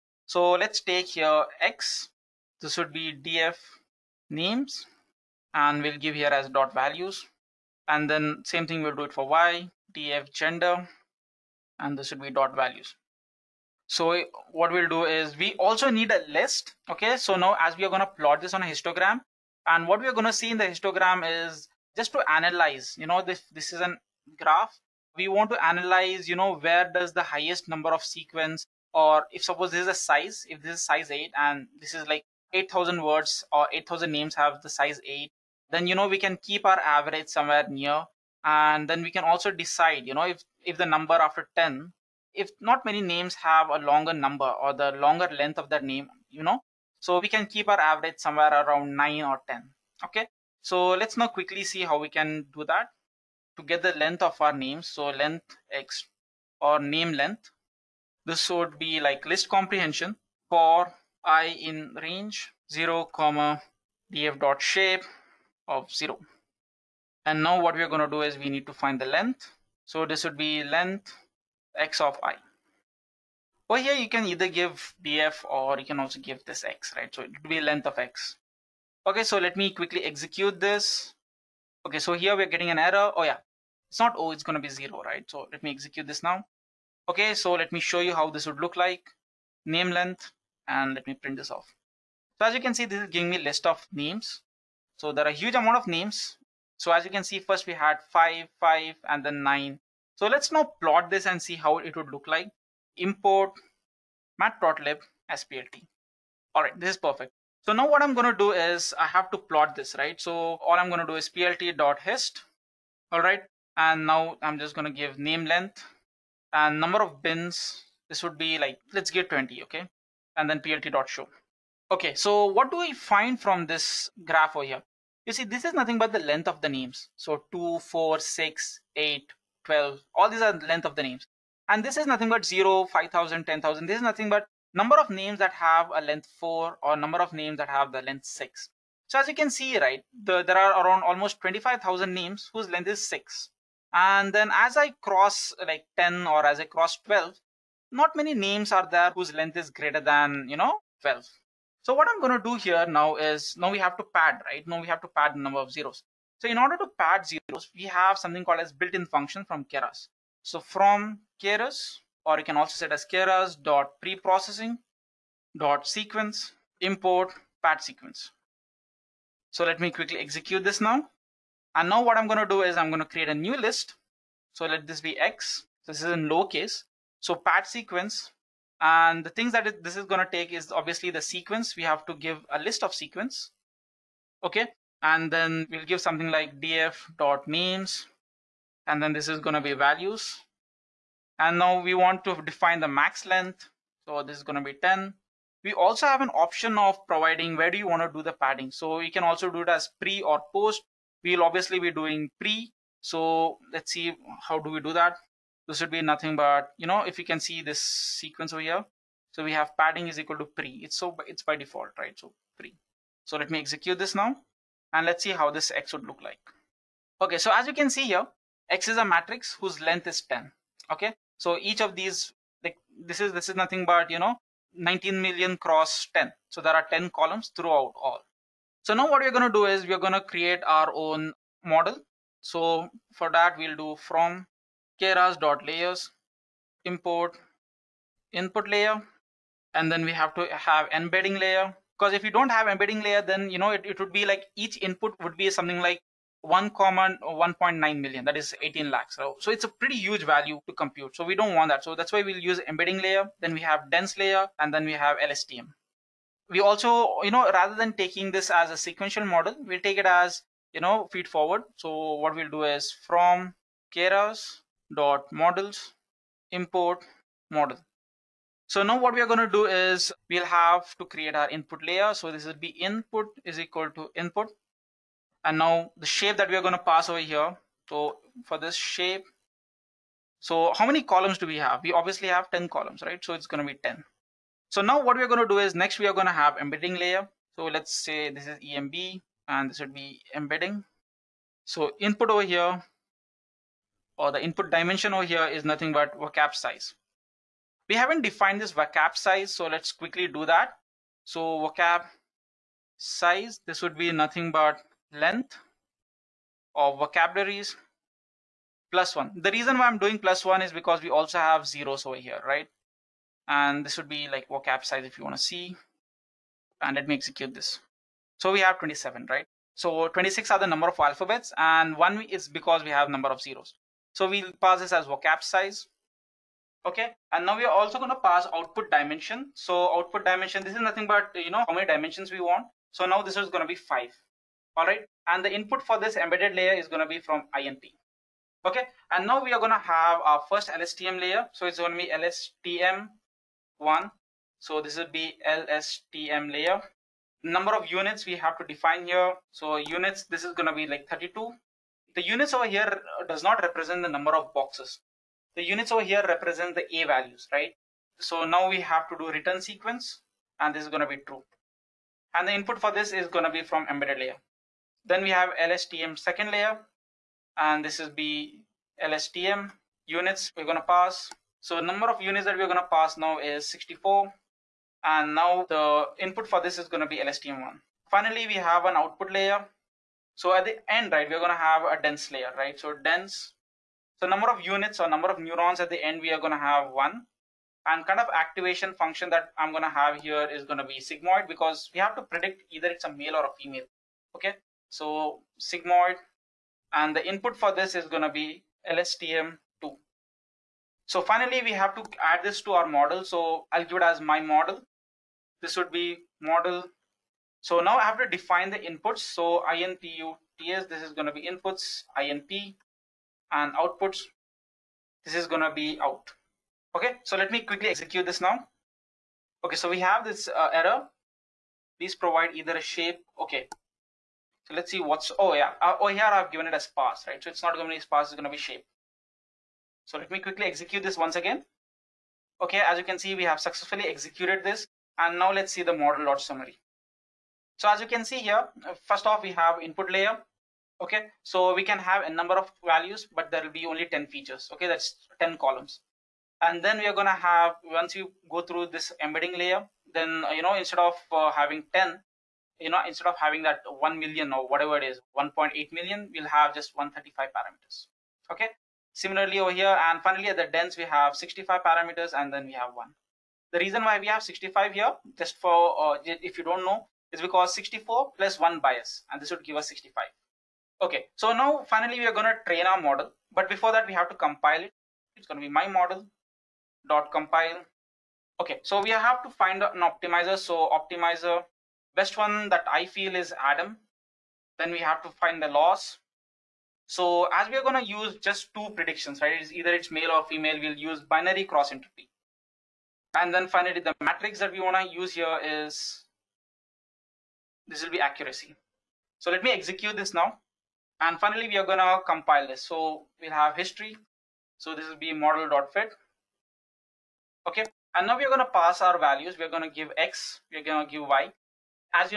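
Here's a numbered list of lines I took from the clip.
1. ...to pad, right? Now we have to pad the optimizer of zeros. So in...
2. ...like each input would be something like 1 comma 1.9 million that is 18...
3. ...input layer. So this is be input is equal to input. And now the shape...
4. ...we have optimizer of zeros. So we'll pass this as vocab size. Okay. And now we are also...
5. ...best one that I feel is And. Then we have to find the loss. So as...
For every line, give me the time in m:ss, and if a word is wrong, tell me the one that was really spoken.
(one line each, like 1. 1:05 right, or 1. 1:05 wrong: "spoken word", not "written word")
1. 2:33 wrong: "number", not "optimizer"
2. 4:04 right
3. 4:31 right
4. 5:22 wrong: "number", not "optimizer"
5. 8:02 wrong: "Adam", not "And".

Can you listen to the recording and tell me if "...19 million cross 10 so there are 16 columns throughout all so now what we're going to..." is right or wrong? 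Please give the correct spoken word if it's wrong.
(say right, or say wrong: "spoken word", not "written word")
wrong: "10", not "16".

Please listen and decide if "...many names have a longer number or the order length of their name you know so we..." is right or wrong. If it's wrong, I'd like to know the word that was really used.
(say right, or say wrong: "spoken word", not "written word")
wrong: "longer", not "order".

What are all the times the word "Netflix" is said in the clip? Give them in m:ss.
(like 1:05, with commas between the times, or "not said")
not said.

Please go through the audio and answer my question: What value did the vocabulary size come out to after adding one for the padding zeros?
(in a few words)
27.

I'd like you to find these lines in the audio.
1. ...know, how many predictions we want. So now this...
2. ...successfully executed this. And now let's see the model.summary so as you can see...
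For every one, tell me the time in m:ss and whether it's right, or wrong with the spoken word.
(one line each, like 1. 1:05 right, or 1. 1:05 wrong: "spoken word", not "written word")
1. 5:31 wrong: "dimensions", not "predictions"
2. 7:13 right.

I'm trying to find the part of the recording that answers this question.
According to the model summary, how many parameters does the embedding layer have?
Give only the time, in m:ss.
7:36.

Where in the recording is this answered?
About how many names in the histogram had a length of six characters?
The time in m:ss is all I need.
2:21.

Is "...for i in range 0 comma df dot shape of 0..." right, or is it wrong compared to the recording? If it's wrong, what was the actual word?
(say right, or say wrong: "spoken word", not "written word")
right.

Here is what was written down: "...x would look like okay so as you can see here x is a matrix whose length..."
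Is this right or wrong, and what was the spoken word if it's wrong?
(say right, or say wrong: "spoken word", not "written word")
right.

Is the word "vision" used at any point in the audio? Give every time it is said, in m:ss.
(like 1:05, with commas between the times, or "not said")
not said.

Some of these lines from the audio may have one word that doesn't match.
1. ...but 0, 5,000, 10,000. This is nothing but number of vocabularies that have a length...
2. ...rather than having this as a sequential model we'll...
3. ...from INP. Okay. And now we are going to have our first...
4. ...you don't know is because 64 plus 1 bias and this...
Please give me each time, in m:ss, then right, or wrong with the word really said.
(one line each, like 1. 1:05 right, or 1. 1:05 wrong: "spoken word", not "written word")
1. 2:12 wrong: "names", not "vocabularies"
2. 4:17 wrong: "taking", not "having"
3. 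5:37 right
4. 7:46 right.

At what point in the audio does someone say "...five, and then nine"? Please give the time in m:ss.
1:38.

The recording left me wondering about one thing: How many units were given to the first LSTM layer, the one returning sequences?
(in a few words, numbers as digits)
32.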